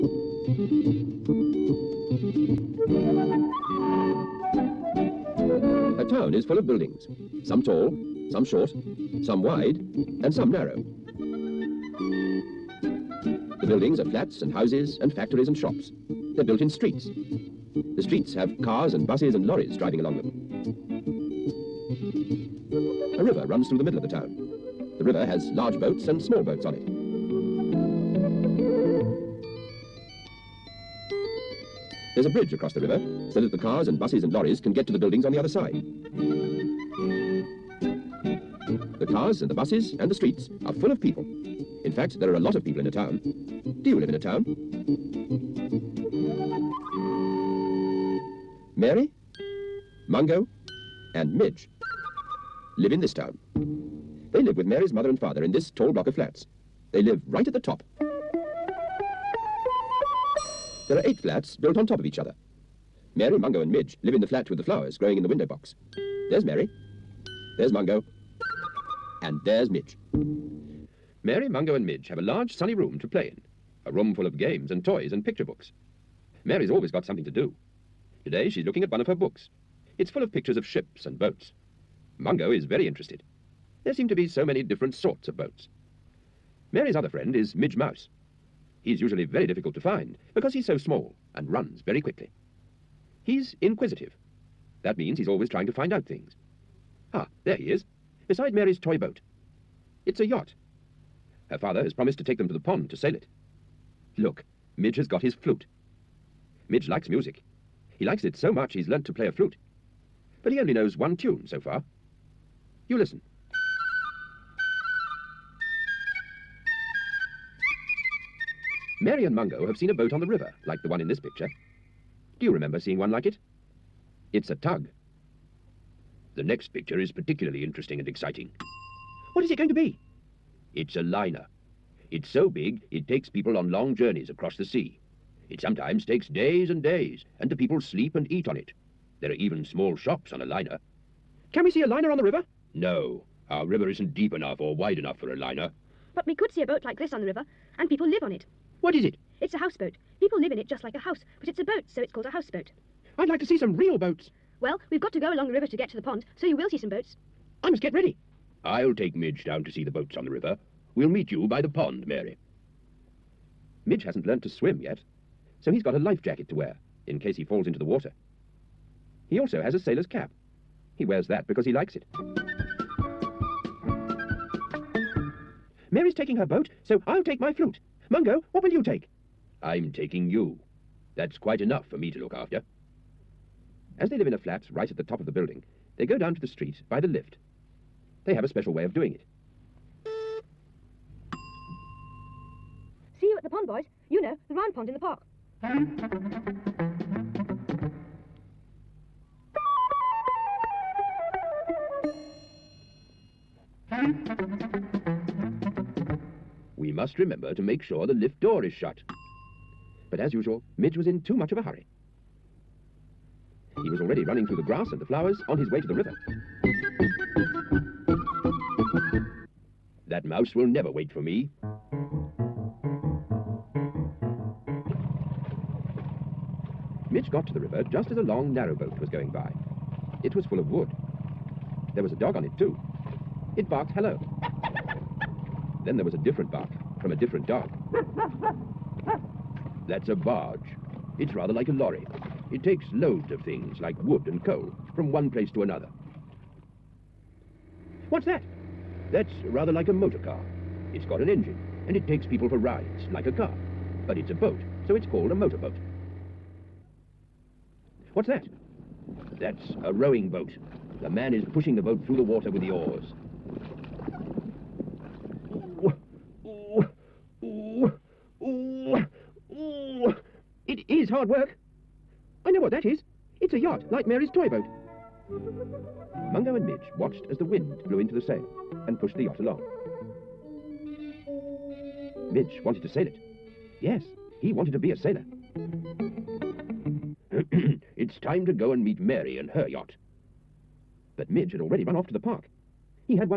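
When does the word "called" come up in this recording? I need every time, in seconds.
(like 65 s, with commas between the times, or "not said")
152 s, 255 s.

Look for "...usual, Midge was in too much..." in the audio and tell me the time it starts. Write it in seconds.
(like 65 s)
210 s.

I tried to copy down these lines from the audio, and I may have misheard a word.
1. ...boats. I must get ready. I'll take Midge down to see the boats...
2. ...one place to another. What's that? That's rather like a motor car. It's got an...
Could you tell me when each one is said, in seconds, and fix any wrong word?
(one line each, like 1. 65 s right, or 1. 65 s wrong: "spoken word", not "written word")
1. 156 s right
2. 245 s right.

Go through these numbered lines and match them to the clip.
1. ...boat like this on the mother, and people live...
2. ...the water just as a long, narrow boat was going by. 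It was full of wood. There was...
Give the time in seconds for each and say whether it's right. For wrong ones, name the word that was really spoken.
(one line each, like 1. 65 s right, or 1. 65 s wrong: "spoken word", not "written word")
1. 146 s wrong: "river", not "mother"
2. 227 s wrong: "river", not "water".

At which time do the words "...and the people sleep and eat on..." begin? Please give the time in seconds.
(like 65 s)
137 s.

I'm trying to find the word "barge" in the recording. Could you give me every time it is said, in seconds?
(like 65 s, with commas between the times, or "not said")
240 s.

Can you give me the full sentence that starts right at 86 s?
Mary's other friend is Midge Mouse.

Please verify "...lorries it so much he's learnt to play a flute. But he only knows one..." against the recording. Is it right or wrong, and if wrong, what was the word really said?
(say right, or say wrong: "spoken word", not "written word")
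wrong: "likes", not "lorries".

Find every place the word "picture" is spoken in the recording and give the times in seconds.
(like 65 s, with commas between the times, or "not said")
75 s, 80 s, 121 s, 126 s.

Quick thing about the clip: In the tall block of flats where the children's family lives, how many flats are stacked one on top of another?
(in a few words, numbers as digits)
8.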